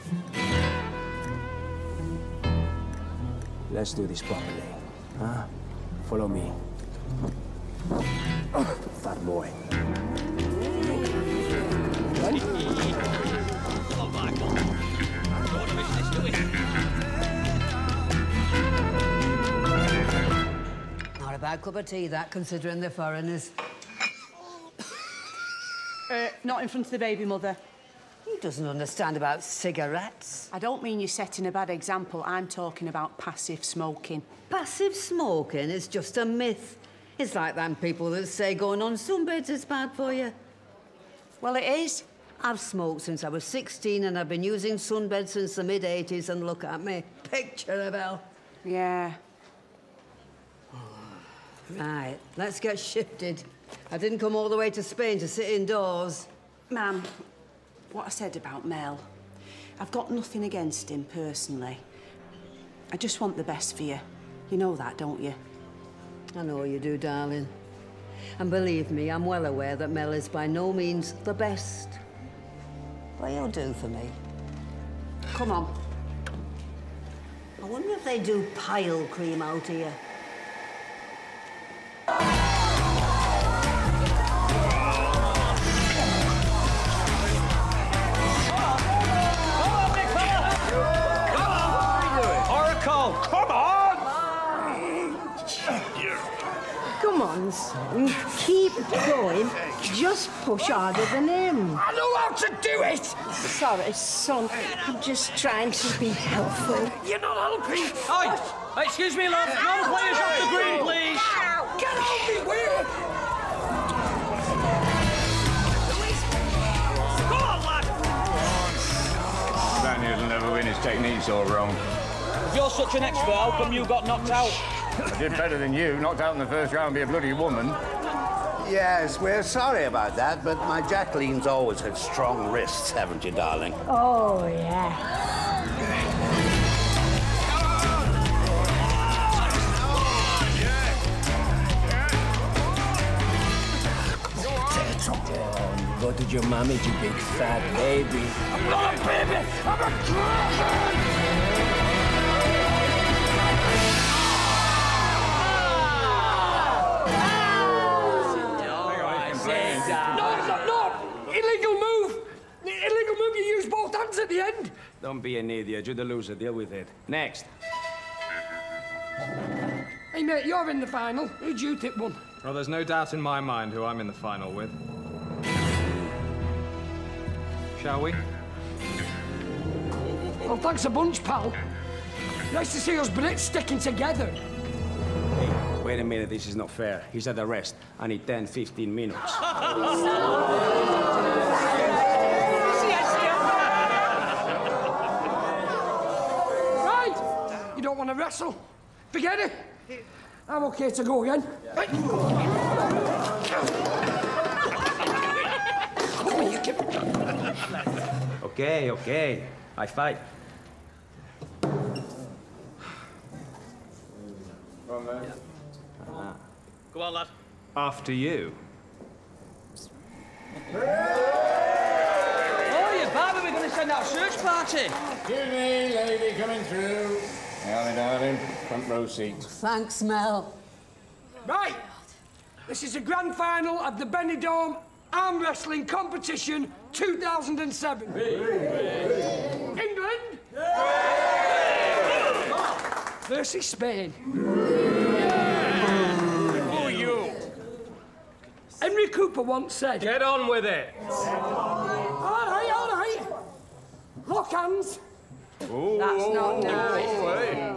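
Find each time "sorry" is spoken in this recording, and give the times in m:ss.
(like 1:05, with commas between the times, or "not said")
1:43, 2:09.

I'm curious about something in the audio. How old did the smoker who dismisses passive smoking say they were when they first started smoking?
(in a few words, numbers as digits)
16.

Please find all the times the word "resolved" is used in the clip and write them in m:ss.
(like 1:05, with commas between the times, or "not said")
not said.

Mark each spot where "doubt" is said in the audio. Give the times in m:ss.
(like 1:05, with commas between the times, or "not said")
2:52.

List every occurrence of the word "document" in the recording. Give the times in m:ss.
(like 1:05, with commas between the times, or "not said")
not said.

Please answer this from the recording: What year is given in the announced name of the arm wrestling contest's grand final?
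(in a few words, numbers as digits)
2007.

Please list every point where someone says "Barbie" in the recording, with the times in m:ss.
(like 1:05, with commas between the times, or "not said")
3:43.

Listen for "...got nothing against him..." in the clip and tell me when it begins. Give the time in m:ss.
0:59.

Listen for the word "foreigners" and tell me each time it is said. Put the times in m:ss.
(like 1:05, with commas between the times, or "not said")
0:22.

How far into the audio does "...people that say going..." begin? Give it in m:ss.
0:37.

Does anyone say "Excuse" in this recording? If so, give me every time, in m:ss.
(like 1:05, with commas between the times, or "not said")
1:48, 3:45.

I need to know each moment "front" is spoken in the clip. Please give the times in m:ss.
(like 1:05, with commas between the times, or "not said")
0:26, 3:48.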